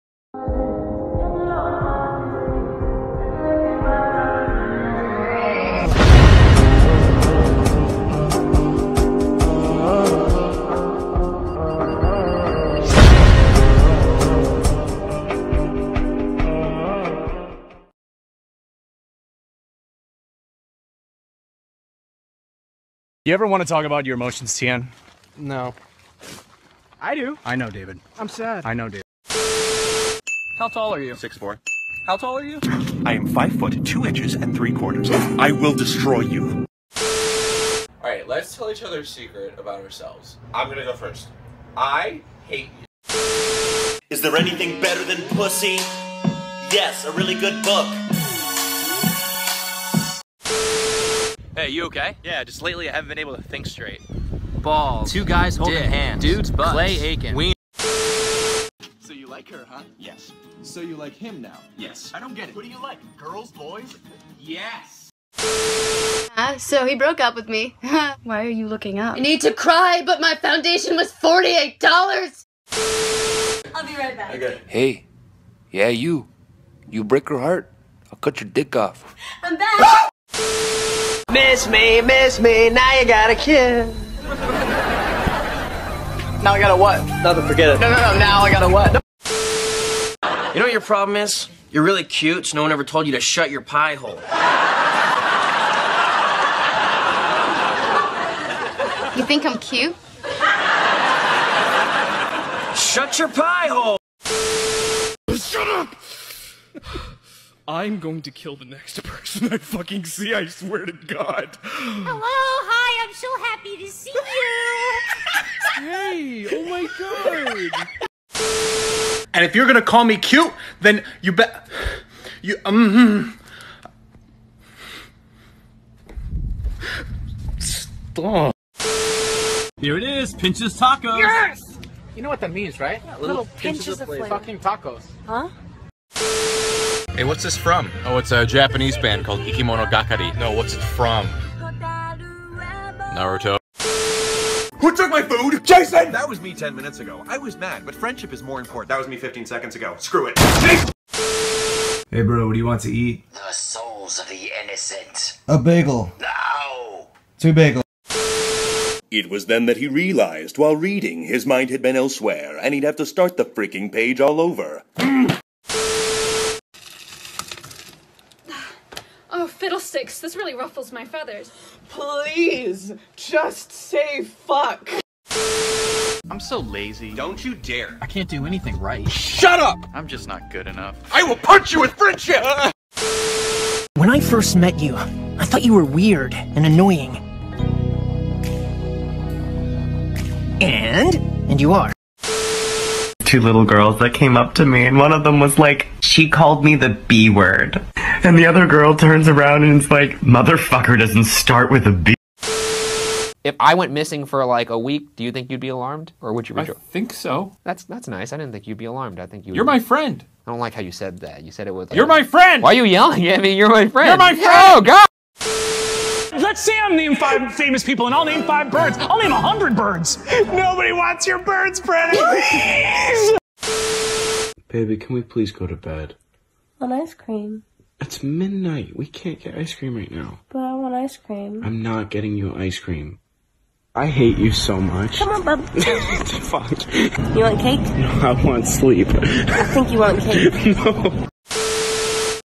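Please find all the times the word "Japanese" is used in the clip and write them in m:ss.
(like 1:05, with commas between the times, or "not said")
2:18.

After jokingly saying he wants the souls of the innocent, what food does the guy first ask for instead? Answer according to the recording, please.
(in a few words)
A bagel.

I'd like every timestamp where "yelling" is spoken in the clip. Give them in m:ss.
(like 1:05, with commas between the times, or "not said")
3:32.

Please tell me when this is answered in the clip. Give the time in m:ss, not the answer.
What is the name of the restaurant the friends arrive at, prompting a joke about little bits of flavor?
2:10.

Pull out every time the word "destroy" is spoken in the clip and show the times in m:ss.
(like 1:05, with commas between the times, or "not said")
0:35.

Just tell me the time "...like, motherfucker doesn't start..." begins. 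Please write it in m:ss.
3:19.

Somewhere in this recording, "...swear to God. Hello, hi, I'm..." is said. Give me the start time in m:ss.
1:50.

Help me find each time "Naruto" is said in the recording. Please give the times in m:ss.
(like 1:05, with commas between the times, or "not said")
2:23.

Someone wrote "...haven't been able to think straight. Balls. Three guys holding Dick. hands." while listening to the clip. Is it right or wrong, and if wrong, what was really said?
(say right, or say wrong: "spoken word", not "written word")
wrong: "Two", not "Three".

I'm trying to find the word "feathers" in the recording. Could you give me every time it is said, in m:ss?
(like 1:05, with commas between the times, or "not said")
2:51.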